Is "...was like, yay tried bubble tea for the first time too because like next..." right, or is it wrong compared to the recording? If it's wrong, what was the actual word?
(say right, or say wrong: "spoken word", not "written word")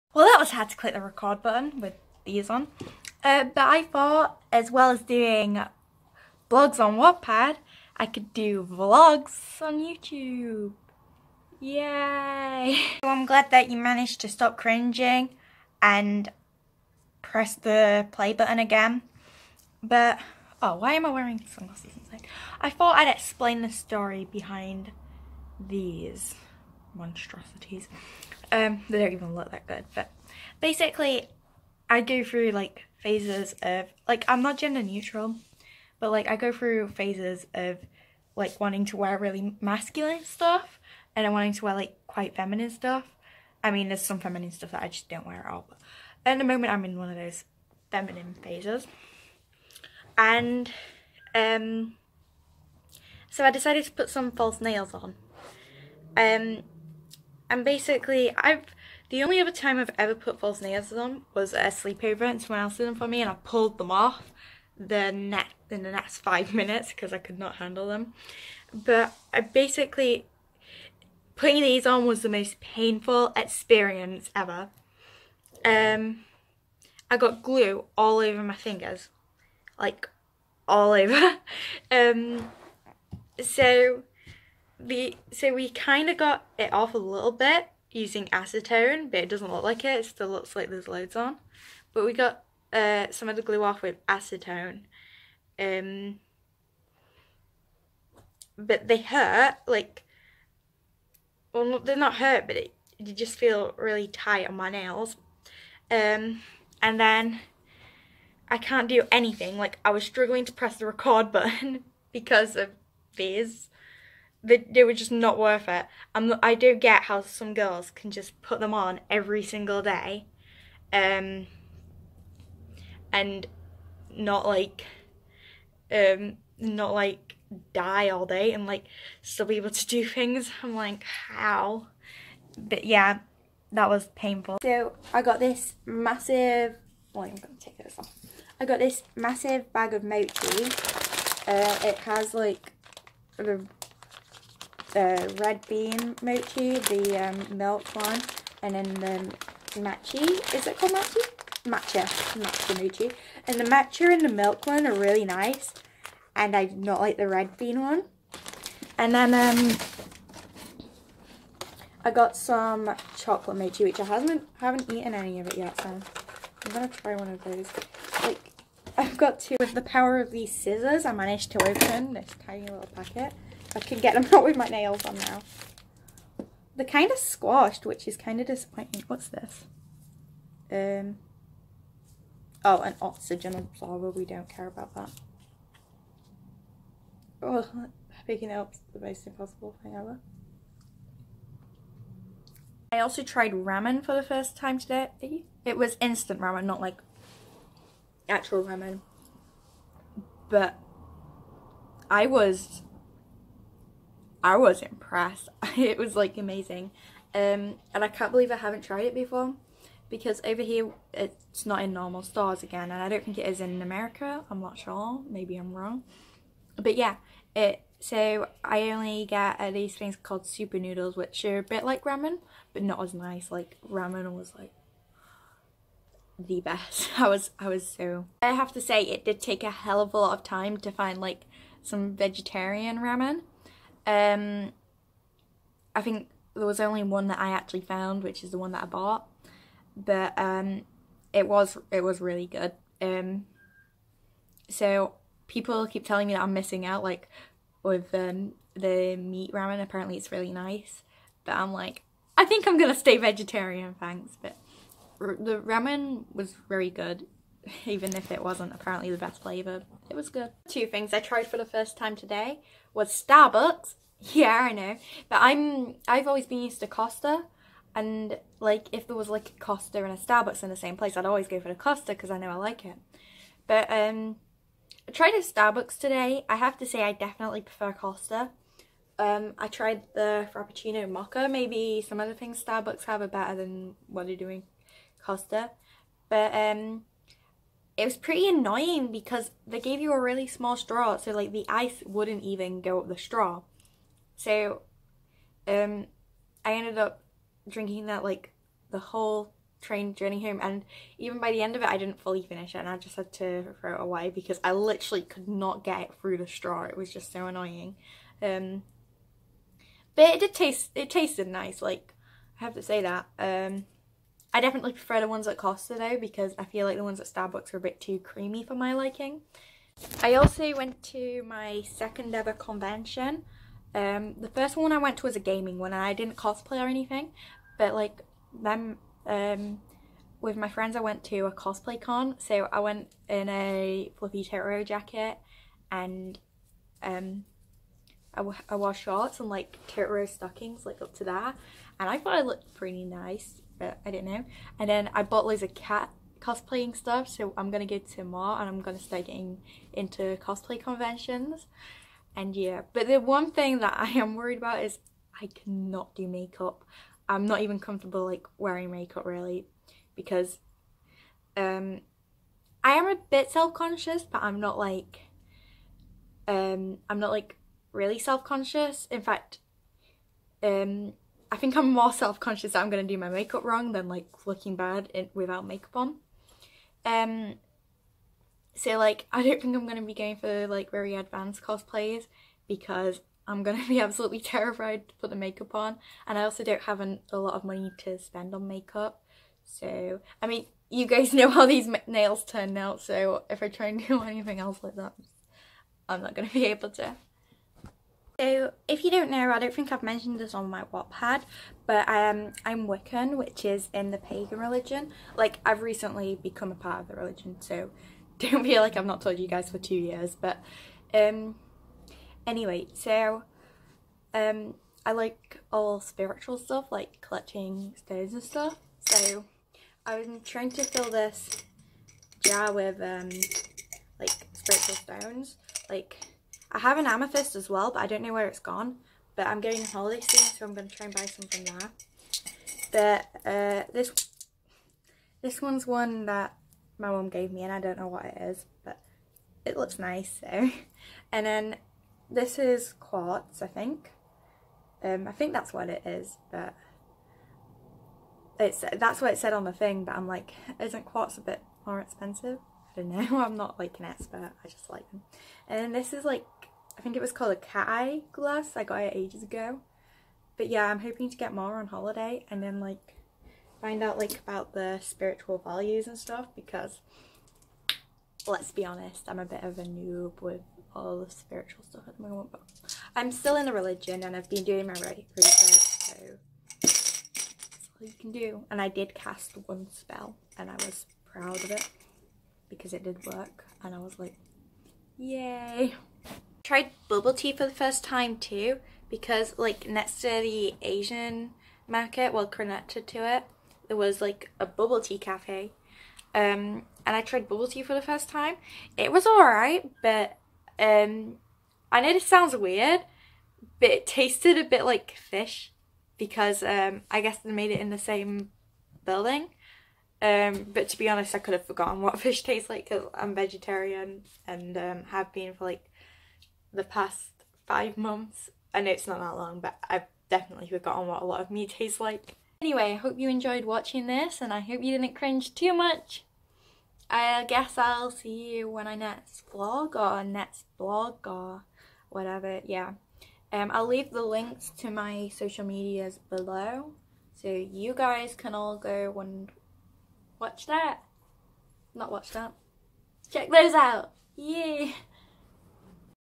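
right.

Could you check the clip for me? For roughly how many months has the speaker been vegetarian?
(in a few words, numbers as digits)
5.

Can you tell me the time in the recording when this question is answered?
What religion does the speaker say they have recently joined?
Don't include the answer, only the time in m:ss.
6:42.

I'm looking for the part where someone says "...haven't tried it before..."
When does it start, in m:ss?
3:28.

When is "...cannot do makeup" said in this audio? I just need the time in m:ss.
5:55.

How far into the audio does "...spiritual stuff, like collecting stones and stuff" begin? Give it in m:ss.
6:55.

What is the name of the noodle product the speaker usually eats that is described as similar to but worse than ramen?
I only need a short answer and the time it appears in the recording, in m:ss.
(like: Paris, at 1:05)
Super noodles, at 3:40.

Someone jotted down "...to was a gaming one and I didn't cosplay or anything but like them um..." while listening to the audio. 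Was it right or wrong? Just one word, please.
right.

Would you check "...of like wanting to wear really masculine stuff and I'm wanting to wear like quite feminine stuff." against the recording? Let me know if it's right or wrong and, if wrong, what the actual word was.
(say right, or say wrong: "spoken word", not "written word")
right.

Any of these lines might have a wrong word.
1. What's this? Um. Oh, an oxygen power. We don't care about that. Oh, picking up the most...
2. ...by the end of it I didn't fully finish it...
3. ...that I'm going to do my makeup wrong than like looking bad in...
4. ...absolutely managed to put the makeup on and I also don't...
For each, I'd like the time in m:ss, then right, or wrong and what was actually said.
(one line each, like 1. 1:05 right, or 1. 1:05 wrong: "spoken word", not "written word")
1. 2:59 wrong: "absorber", not "power"
2. 5:01 right
3. 6:12 right
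4. 6:23 wrong: "terrified", not "managed".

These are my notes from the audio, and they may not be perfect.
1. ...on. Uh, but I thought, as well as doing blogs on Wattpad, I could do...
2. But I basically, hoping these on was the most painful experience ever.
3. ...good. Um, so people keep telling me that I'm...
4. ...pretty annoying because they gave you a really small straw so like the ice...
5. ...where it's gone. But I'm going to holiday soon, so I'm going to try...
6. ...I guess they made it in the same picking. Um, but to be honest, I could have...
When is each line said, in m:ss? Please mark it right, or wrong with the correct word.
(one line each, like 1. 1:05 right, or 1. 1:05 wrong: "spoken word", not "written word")
1. 0:02 right
2. 1:08 wrong: "putting", not "hoping"
3. 4:02 right
4. 4:48 right
5. 7:08 right
6. 8:27 wrong: "building", not "picking".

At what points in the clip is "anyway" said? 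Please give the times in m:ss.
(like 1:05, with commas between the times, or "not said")
6:52, 8:42.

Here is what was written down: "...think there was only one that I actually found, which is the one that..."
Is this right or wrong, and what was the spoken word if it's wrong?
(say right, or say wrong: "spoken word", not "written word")
right.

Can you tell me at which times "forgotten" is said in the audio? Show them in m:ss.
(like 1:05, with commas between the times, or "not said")
8:31, 8:40.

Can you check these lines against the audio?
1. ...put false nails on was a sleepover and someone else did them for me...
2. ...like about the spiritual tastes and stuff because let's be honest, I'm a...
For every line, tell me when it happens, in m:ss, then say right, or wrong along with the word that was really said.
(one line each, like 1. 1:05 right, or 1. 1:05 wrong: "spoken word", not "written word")
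1. 1:00 right
2. 7:44 wrong: "values", not "tastes".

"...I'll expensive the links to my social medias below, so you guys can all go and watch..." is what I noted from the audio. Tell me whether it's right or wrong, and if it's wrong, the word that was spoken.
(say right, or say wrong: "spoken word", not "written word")
wrong: "leave", not "expensive".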